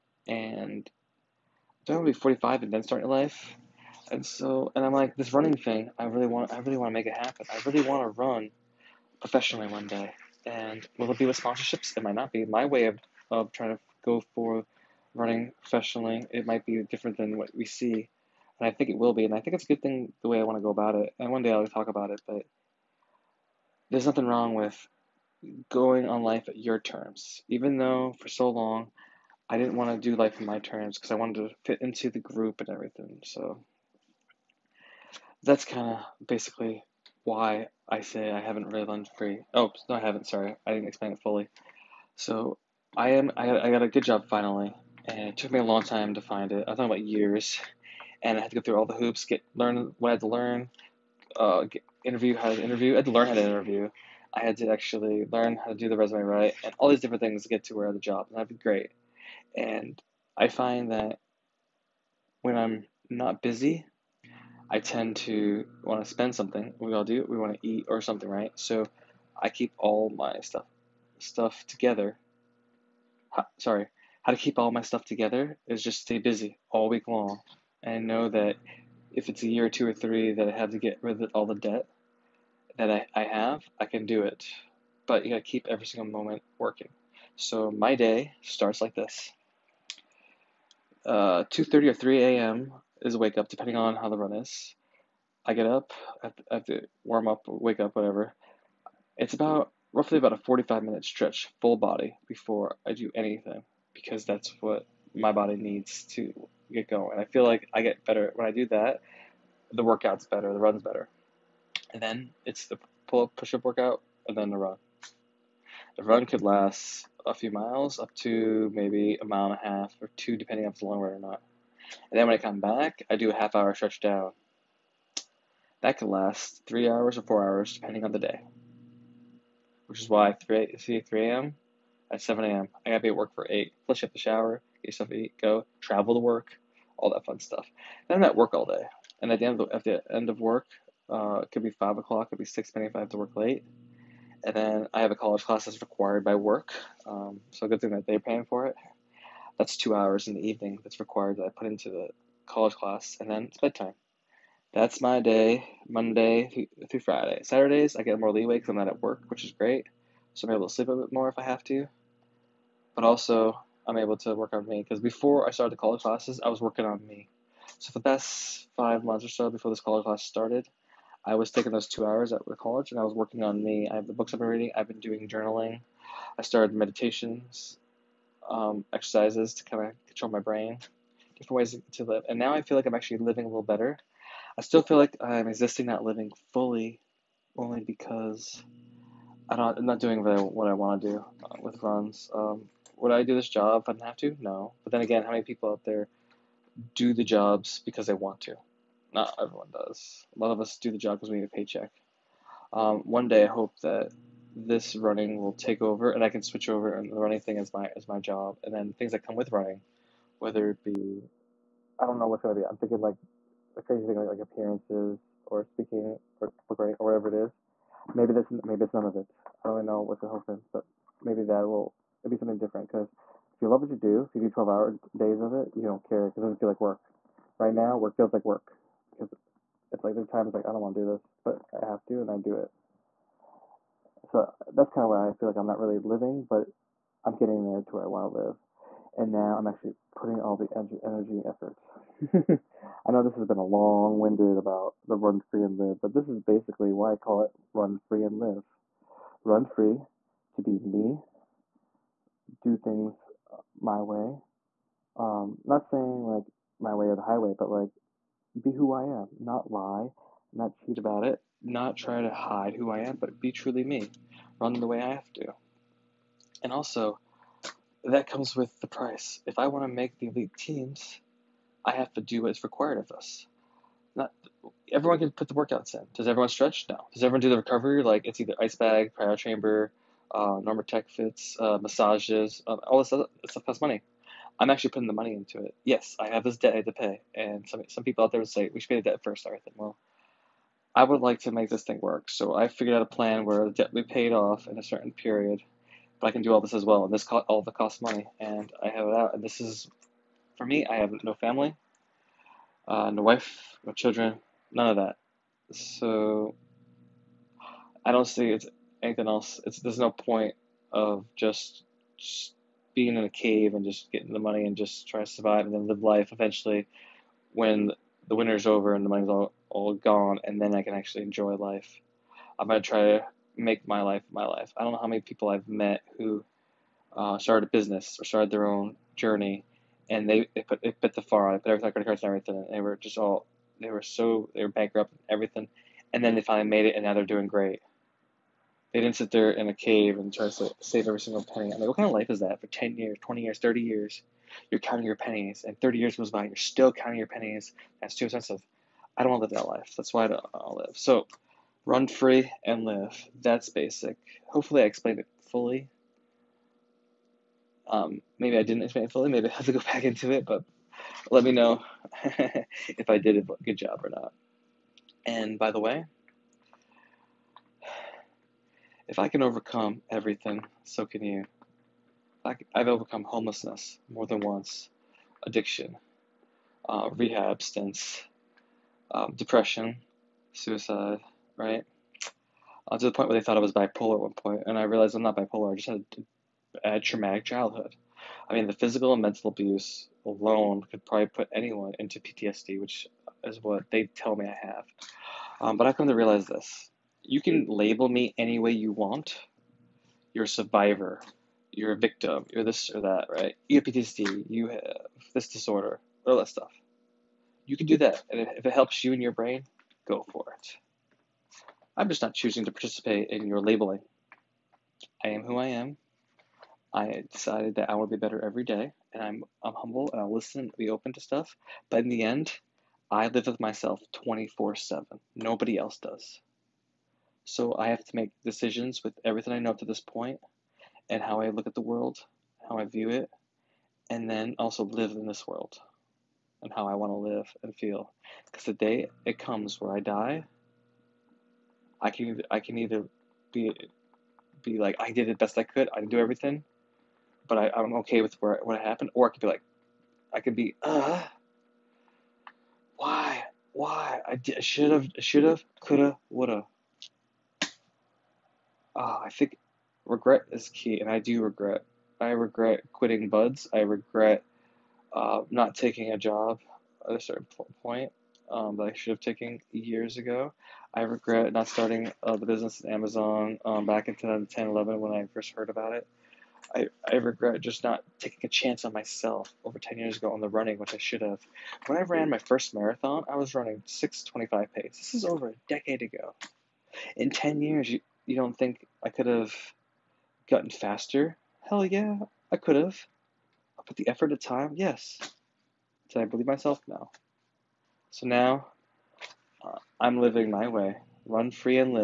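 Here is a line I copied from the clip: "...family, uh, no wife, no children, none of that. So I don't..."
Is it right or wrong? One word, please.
right.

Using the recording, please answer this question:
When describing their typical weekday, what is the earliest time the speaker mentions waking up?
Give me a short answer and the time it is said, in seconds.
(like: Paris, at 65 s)
2:30 a.m., at 91 s.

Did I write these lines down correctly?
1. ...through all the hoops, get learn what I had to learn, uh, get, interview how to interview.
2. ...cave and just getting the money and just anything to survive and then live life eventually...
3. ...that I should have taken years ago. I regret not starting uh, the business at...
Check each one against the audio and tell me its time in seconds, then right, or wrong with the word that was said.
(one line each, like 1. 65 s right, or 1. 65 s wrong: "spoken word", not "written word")
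1. 48 s right
2. 313 s wrong: "trying", not "anything"
3. 468 s right.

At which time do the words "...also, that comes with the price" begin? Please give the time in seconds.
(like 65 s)
266 s.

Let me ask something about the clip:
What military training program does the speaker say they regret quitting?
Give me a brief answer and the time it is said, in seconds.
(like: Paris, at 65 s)
BUD/S, at 463 s.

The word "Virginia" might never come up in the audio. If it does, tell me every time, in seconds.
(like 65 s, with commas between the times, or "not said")
not said.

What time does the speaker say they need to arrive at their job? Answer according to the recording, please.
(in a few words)
8.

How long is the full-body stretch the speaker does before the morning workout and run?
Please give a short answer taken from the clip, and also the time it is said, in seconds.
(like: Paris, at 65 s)
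45 minutes, at 100 s.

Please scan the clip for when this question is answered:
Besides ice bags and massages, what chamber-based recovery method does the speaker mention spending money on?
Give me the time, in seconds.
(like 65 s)
279 s.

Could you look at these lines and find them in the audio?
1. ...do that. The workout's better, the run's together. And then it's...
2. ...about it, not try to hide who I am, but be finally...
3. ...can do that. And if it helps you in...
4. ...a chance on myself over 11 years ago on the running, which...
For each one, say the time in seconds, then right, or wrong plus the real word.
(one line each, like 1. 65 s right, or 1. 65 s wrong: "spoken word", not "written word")
1. 108 s wrong: "better", not "together"
2. 260 s wrong: "truly", not "finally"
3. 407 s right
4. 478 s wrong: "10", not "11".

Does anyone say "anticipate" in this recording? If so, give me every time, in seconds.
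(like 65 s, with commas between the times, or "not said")
not said.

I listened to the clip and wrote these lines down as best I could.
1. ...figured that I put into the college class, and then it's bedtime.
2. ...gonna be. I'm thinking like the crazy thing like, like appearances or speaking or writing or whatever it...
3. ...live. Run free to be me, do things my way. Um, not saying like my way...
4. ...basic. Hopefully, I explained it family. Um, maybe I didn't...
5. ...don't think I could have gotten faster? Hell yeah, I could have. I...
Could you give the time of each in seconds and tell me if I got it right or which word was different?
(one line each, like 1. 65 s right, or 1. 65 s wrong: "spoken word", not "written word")
1. 150 s wrong: "required", not "figured"
2. 212 s right
3. 248 s right
4. 353 s wrong: "fully", not "family"
5. 488 s right.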